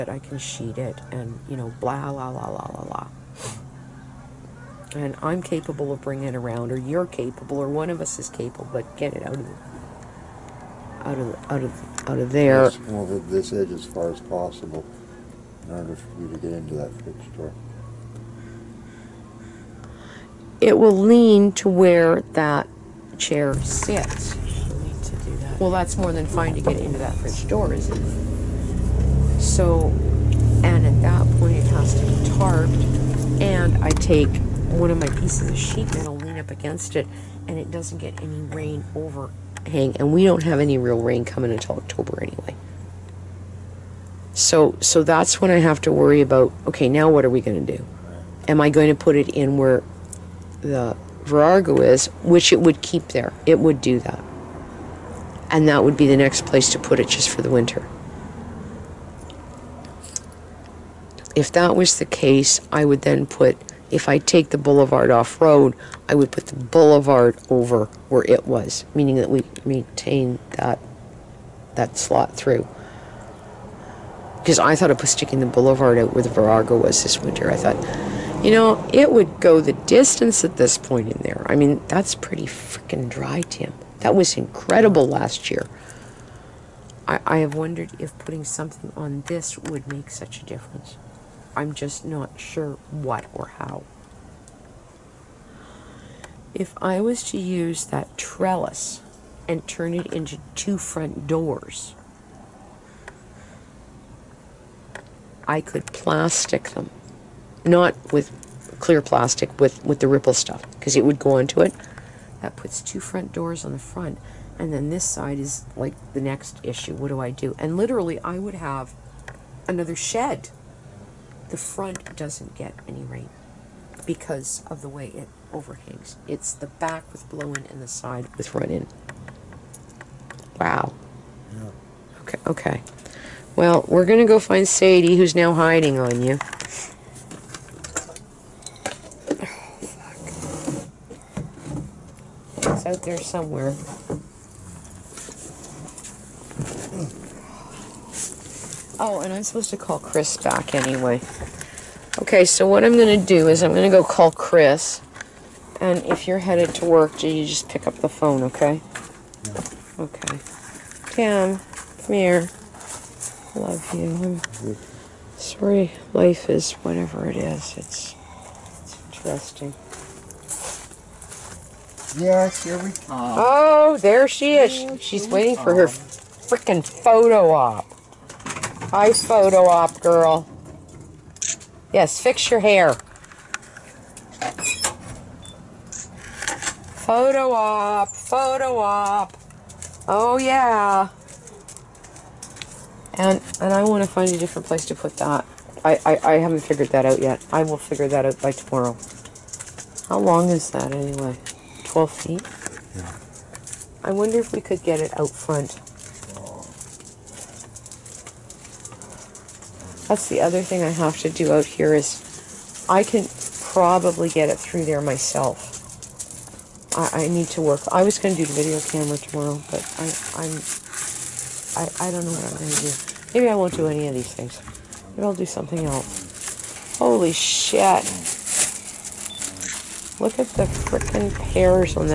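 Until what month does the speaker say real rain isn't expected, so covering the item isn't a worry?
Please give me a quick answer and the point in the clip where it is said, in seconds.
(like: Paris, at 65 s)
October, at 41 s.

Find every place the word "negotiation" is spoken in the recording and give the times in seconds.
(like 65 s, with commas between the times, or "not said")
not said.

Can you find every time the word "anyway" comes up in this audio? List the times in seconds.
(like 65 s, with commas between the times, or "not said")
42 s, 150 s, 200 s.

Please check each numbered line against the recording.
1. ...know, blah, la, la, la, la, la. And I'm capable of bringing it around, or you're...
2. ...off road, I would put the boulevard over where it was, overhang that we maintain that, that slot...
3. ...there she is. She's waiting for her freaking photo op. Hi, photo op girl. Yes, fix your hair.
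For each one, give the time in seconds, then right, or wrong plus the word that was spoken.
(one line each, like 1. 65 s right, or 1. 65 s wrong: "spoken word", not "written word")
1. 1 s right
2. 65 s wrong: "meaning", not "overhang"
3. 173 s right.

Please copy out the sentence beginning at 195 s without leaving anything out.
I, I, I haven't figured that out yet.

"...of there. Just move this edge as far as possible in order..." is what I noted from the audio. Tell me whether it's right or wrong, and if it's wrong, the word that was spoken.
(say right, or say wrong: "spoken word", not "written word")
right.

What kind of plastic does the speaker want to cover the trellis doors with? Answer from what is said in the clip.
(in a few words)
ripple.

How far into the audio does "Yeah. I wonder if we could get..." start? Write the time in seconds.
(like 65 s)
202 s.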